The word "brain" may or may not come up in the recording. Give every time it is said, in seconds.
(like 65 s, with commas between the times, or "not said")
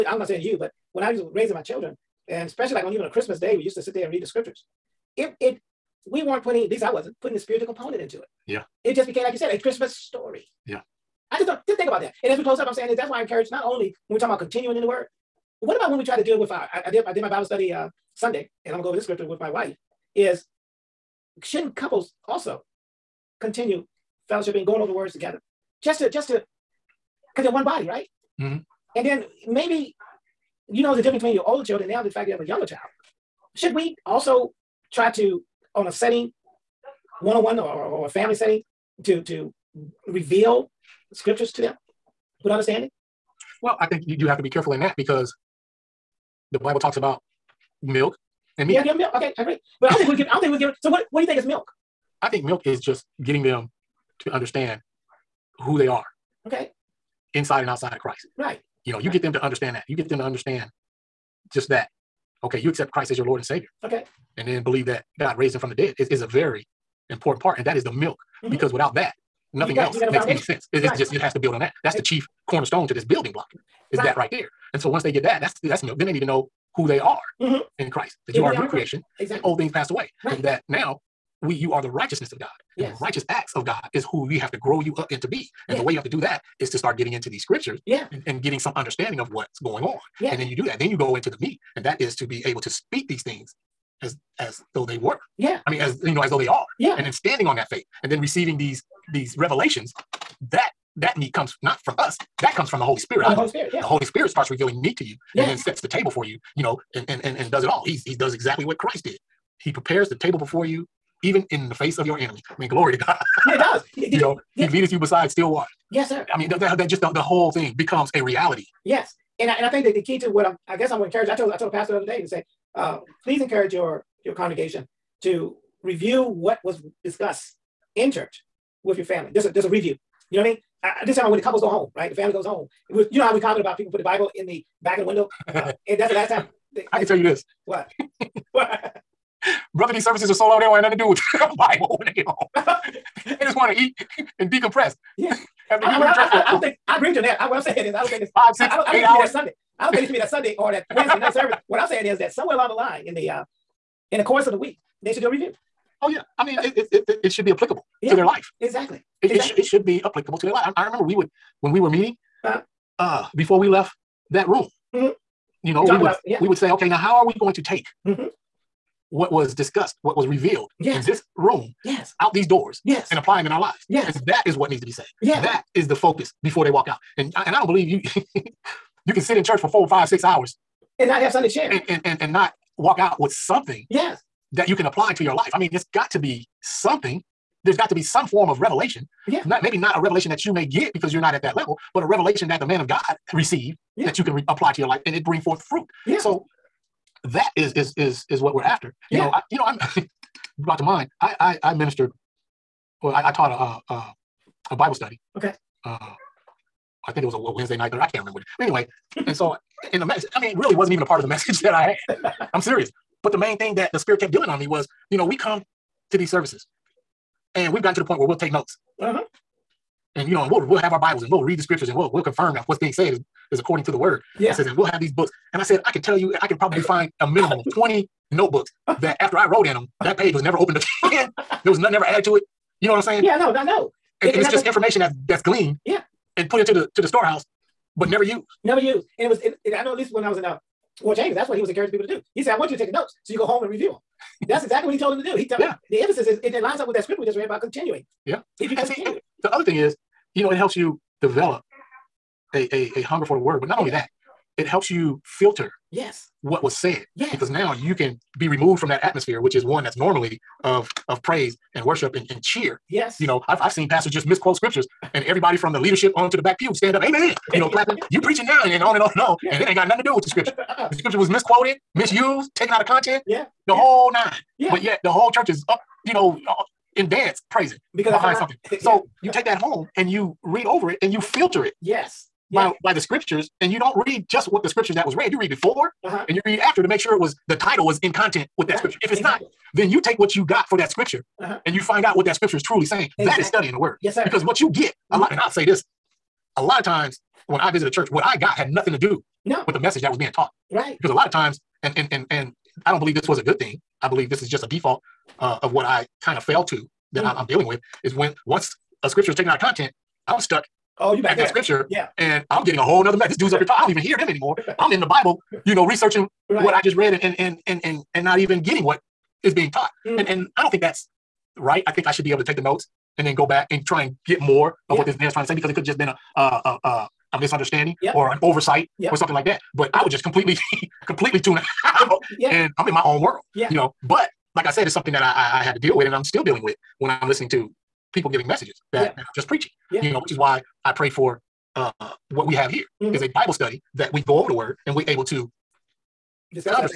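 not said.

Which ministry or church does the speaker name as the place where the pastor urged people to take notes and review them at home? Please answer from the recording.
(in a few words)
World Changers.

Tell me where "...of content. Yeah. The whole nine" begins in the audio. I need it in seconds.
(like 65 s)
272 s.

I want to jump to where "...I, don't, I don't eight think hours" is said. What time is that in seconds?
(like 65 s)
148 s.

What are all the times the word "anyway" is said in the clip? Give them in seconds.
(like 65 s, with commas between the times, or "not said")
208 s.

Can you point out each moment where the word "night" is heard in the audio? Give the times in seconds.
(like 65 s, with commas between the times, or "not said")
151 s, 207 s.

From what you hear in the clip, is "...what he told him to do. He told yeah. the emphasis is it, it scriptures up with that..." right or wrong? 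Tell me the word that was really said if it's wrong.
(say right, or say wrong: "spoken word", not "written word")
wrong: "lines", not "scriptures".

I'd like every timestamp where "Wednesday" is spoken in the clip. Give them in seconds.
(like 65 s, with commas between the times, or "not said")
150 s, 207 s.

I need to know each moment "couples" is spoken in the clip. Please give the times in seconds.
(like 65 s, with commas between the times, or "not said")
21 s, 131 s.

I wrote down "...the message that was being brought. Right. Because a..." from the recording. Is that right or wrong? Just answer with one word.
wrong.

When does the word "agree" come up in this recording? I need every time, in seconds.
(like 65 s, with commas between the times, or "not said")
49 s, 146 s.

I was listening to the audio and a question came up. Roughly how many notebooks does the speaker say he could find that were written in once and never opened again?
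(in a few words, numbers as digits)
20.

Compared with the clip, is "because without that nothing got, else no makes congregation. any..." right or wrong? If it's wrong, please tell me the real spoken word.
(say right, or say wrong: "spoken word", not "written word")
wrong: "foundation", not "congregation".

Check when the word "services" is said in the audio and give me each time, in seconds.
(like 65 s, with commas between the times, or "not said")
140 s, 151 s, 216 s.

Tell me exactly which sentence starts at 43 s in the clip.
Well, I think you have to be careful in that because the Bible talks about milk and meat.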